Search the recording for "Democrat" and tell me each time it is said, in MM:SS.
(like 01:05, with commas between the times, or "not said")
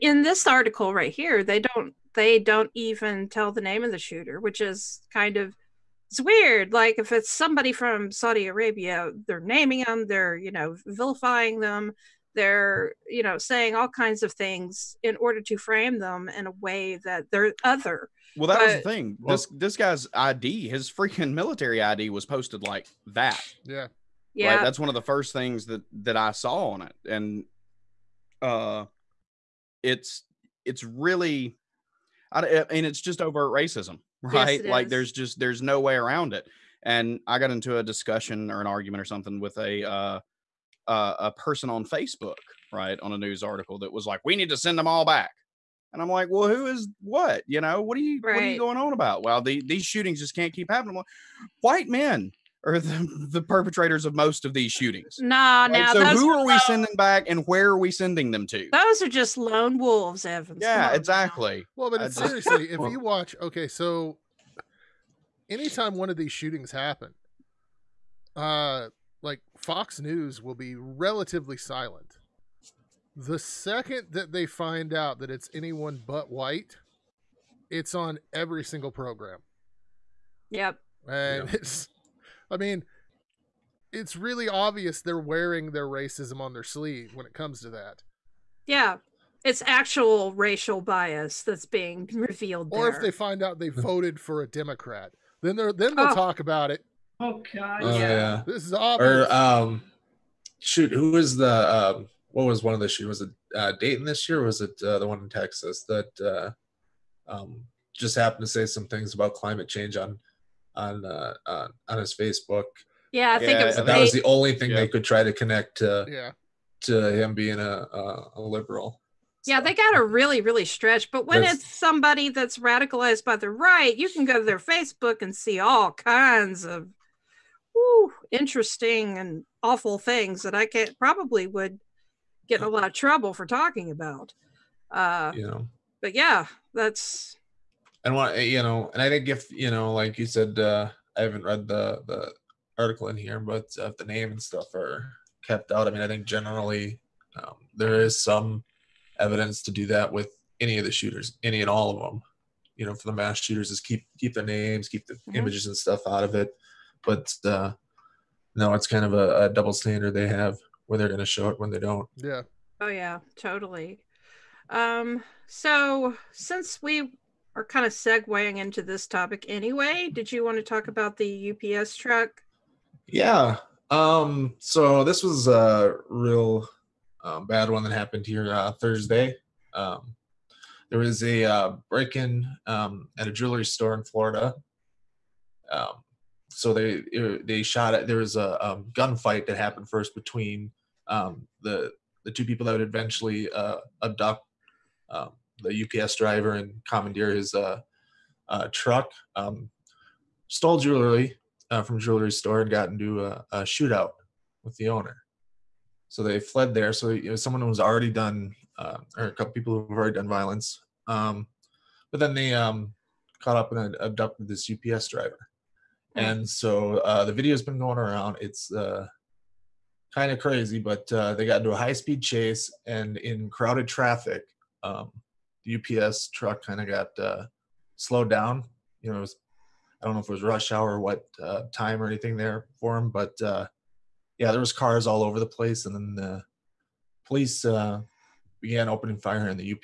01:34.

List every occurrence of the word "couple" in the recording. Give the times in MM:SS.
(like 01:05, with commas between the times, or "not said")
03:29.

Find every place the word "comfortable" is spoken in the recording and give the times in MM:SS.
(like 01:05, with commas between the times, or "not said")
not said.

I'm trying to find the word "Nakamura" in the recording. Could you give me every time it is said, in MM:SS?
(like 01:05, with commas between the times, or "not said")
not said.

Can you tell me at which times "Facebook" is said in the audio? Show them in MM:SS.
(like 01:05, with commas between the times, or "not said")
00:41, 01:52, 02:04.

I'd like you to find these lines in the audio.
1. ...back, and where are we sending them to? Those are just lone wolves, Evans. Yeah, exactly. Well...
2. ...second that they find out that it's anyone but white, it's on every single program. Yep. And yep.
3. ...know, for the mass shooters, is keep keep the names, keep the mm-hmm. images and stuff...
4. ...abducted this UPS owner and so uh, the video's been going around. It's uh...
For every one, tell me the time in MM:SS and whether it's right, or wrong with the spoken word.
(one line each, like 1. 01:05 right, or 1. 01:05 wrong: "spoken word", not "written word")
1. 00:56 right
2. 01:13 right
3. 02:32 right
4. 03:33 wrong: "driver", not "owner".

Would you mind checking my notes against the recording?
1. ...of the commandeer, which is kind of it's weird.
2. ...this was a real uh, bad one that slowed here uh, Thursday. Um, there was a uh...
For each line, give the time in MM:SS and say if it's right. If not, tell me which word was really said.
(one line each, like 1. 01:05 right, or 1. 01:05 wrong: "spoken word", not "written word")
1. 00:03 wrong: "shooter", not "commandeer"
2. 02:55 wrong: "happened", not "slowed".